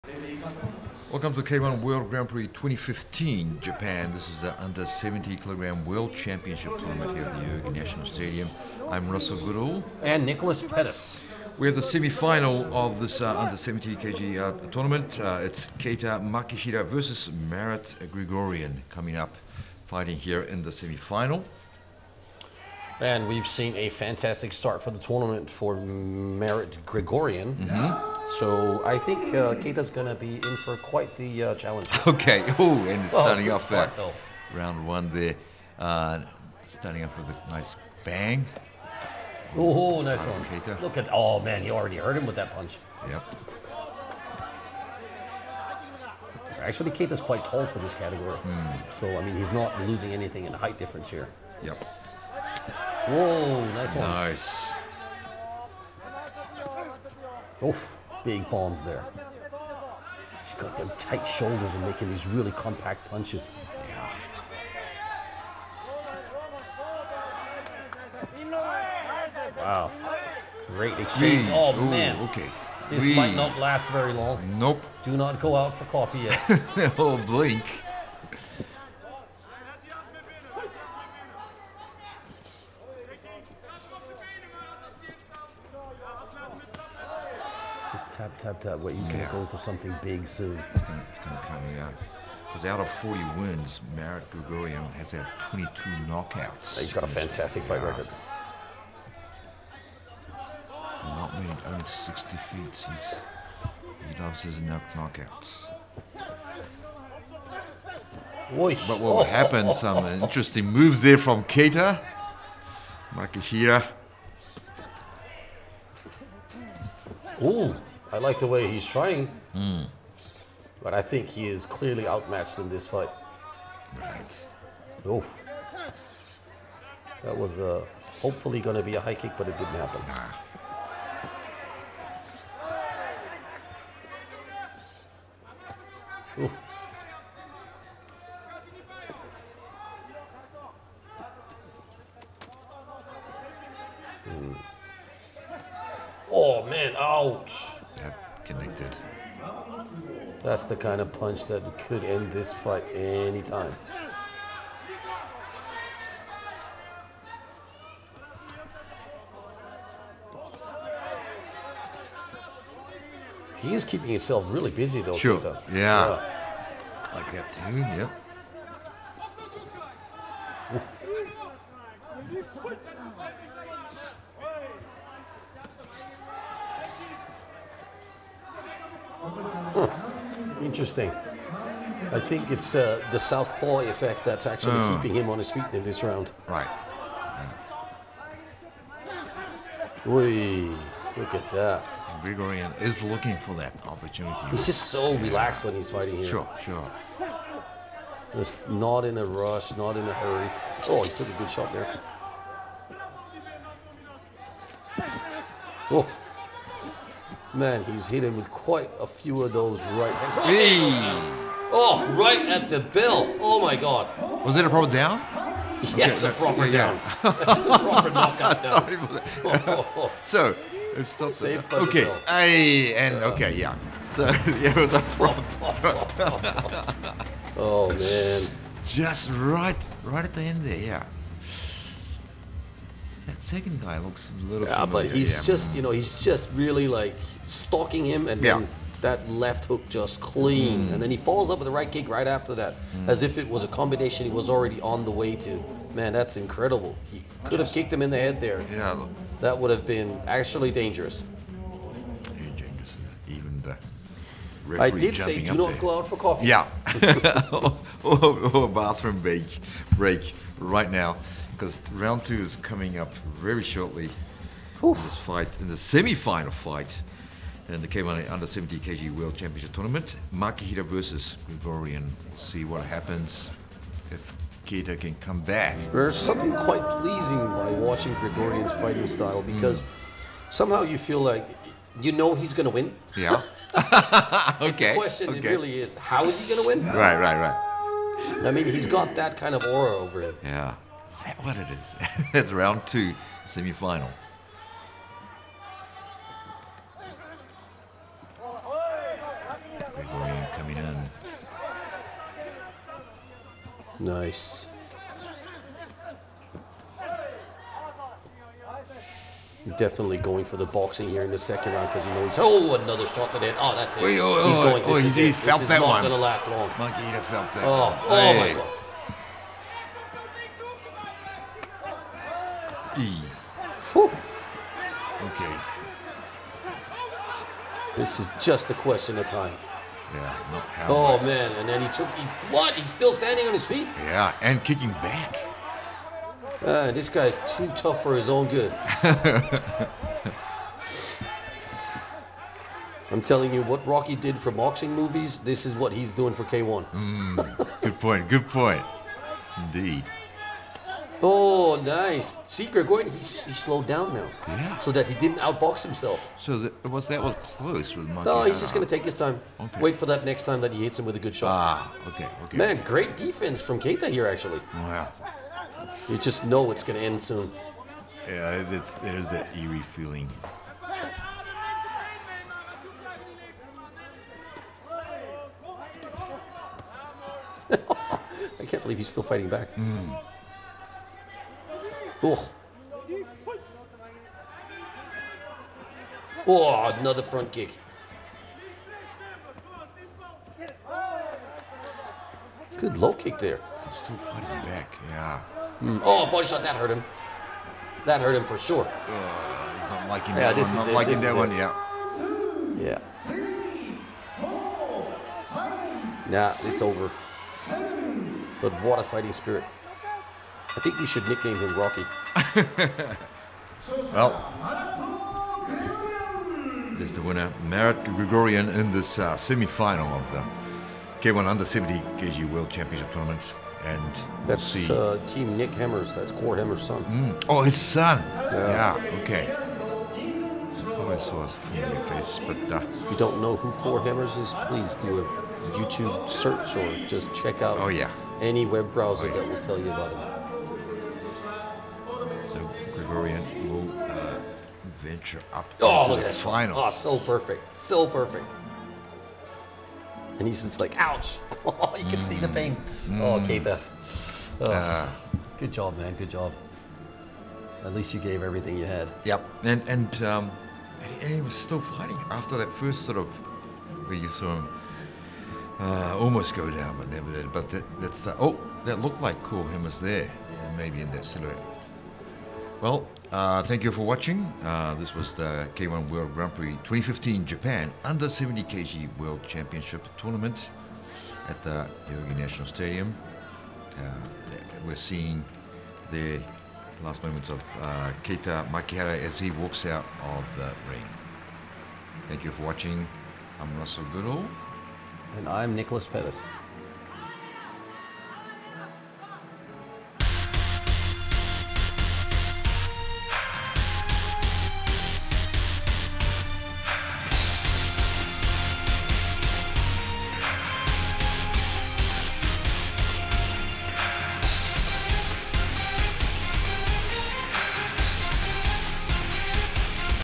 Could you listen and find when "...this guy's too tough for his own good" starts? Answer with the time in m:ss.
5:36.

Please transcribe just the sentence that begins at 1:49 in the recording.
happened, some interesting moves there from Keita.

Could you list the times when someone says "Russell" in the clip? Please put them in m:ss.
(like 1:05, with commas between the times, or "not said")
0:09, 8:13.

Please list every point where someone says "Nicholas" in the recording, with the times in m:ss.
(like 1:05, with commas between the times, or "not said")
0:10, 8:15.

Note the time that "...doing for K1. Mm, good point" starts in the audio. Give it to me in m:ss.
5:46.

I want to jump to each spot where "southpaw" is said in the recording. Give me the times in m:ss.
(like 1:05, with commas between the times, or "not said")
3:03.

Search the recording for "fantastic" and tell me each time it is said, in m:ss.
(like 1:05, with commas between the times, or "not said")
0:23, 1:37.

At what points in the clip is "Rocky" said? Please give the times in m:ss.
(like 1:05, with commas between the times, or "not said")
5:43, 6:51.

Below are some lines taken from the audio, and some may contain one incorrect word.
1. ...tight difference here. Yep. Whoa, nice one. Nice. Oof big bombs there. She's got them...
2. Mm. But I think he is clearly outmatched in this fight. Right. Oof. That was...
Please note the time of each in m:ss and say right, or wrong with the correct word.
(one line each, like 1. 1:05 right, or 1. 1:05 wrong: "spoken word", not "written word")
1. 0:50 wrong: "height", not "tight"
2. 1:59 right.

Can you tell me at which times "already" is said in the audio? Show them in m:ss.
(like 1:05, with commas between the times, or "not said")
0:41, 4:04.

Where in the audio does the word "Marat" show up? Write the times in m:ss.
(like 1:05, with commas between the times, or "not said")
0:17, 0:25, 1:33, 6:57.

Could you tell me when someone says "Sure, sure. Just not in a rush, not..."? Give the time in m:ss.
3:16.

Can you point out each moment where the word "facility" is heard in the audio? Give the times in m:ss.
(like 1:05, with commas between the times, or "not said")
not said.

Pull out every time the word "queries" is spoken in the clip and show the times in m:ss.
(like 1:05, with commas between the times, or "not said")
not said.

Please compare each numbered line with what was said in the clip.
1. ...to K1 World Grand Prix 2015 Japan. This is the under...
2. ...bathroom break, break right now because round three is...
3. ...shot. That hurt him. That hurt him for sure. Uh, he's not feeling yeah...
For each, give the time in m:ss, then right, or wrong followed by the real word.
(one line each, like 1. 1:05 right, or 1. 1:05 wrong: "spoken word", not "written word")
1. 0:01 right
2. 4:18 wrong: "two", not "three"
3. 6:36 wrong: "liking", not "feeling".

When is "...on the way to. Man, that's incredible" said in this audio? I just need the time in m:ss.
4:04.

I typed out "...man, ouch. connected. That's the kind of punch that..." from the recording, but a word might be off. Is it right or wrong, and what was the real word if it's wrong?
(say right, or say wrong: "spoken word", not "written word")
right.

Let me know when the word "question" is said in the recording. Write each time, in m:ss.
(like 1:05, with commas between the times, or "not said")
4:44, 5:28.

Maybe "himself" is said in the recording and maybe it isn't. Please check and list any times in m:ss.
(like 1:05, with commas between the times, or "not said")
2:44, 5:55.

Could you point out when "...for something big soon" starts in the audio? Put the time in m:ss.
1:29.